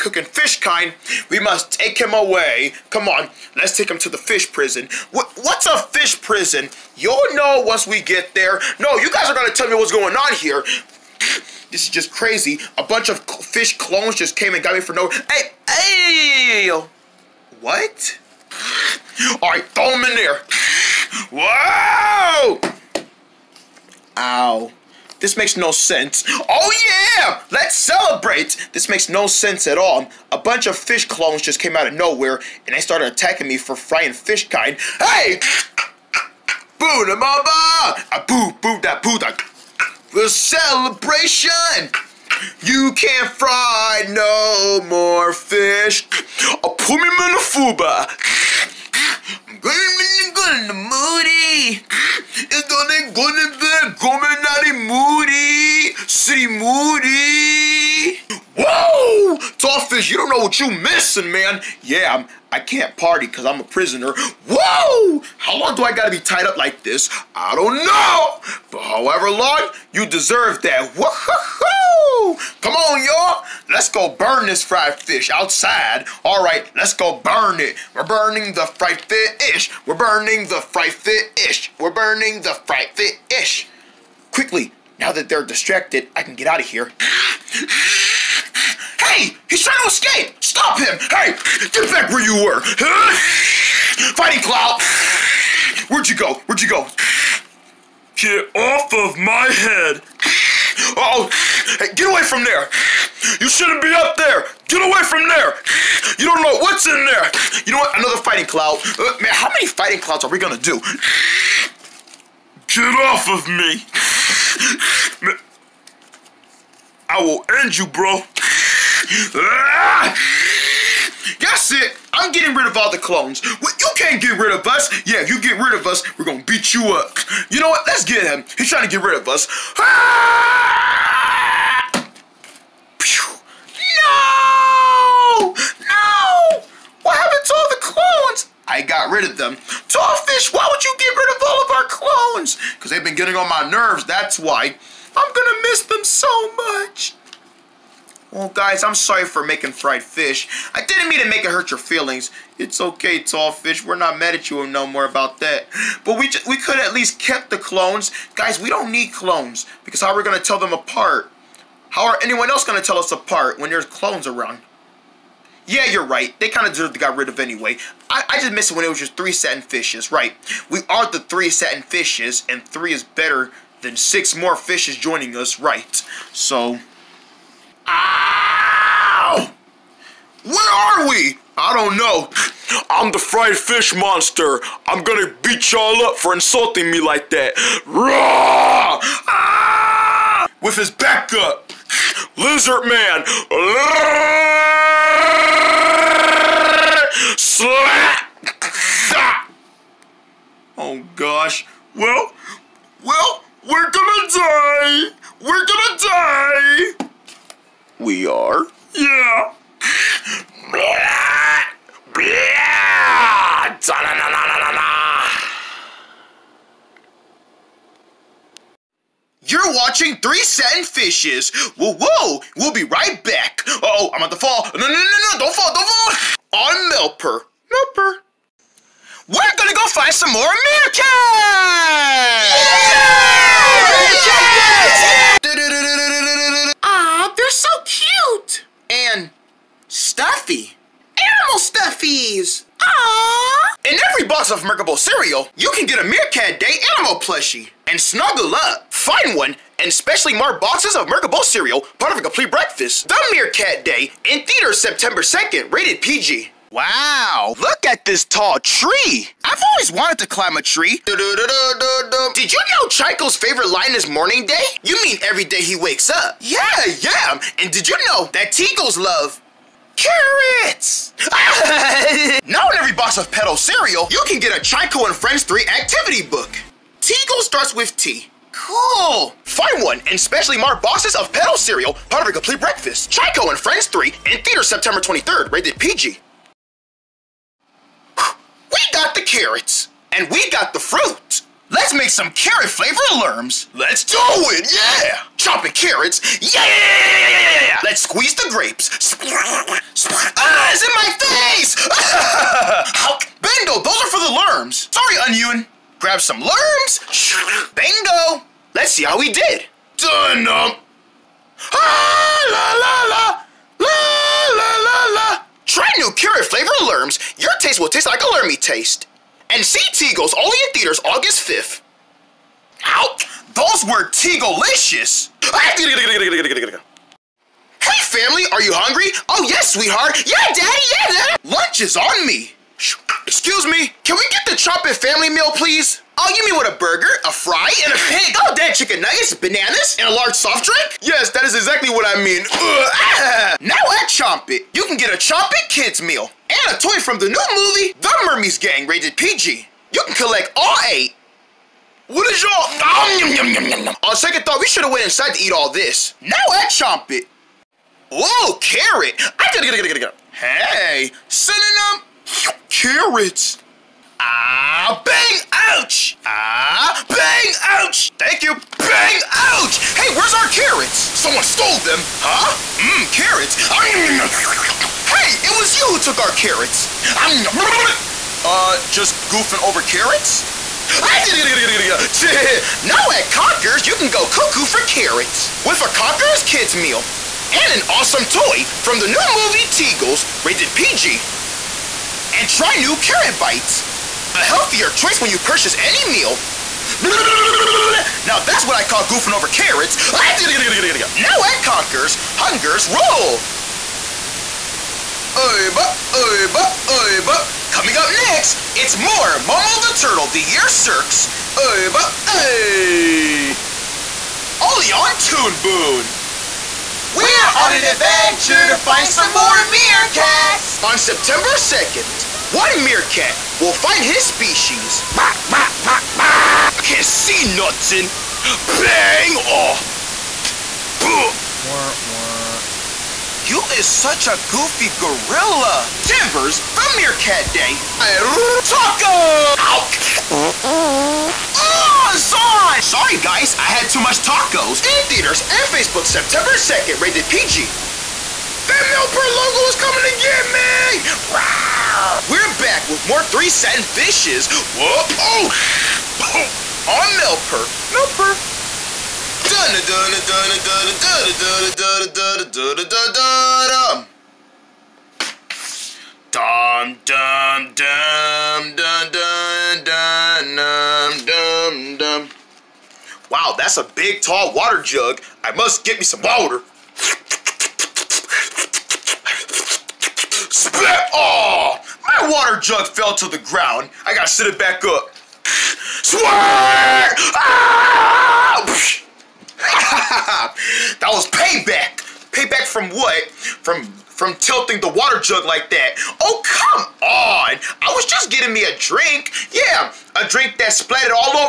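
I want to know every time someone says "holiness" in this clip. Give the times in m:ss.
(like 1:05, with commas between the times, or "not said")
not said.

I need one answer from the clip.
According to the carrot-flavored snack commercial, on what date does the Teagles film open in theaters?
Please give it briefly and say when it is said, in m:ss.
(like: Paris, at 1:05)
August 5th, at 5:21.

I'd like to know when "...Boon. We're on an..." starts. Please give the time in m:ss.
6:55.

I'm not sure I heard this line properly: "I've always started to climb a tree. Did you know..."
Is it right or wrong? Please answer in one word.
wrong.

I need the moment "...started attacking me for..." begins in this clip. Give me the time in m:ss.
0:32.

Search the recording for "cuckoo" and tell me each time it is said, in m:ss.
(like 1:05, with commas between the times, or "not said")
6:24.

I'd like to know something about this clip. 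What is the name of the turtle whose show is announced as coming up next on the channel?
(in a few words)
Momo.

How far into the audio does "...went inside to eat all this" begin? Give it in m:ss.
5:54.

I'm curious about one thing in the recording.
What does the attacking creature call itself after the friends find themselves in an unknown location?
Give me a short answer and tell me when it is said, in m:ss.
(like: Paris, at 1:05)
fried fish monster, at 3:03.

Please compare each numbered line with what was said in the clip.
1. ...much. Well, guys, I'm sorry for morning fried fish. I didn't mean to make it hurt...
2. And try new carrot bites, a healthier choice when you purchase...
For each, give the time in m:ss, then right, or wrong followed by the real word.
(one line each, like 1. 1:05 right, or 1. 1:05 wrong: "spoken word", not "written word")
1. 2:26 wrong: "making", not "morning"
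2. 6:32 right.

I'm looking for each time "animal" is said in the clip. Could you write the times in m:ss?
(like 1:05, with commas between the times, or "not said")
4:01, 4:06.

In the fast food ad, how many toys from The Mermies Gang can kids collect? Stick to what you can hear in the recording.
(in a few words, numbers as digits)
8.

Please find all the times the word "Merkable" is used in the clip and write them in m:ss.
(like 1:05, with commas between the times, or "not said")
4:04, 4:11.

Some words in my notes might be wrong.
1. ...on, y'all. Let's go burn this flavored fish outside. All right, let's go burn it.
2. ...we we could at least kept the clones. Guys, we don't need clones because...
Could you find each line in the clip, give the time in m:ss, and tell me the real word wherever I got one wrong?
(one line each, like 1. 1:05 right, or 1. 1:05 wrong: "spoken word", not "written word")
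1. 1:12 wrong: "fried", not "flavored"
2. 2:36 right.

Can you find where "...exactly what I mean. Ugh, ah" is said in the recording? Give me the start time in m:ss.
5:41.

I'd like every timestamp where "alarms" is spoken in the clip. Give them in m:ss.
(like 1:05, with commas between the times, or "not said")
4:53.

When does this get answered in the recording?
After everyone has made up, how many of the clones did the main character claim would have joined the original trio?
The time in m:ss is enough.
2:53.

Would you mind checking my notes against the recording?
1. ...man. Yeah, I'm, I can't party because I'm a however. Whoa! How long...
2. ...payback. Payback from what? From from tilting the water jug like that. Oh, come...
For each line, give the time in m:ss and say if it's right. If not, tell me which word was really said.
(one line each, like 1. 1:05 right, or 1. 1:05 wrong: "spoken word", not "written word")
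1. 1:01 wrong: "prisoner", not "however"
2. 8:11 right.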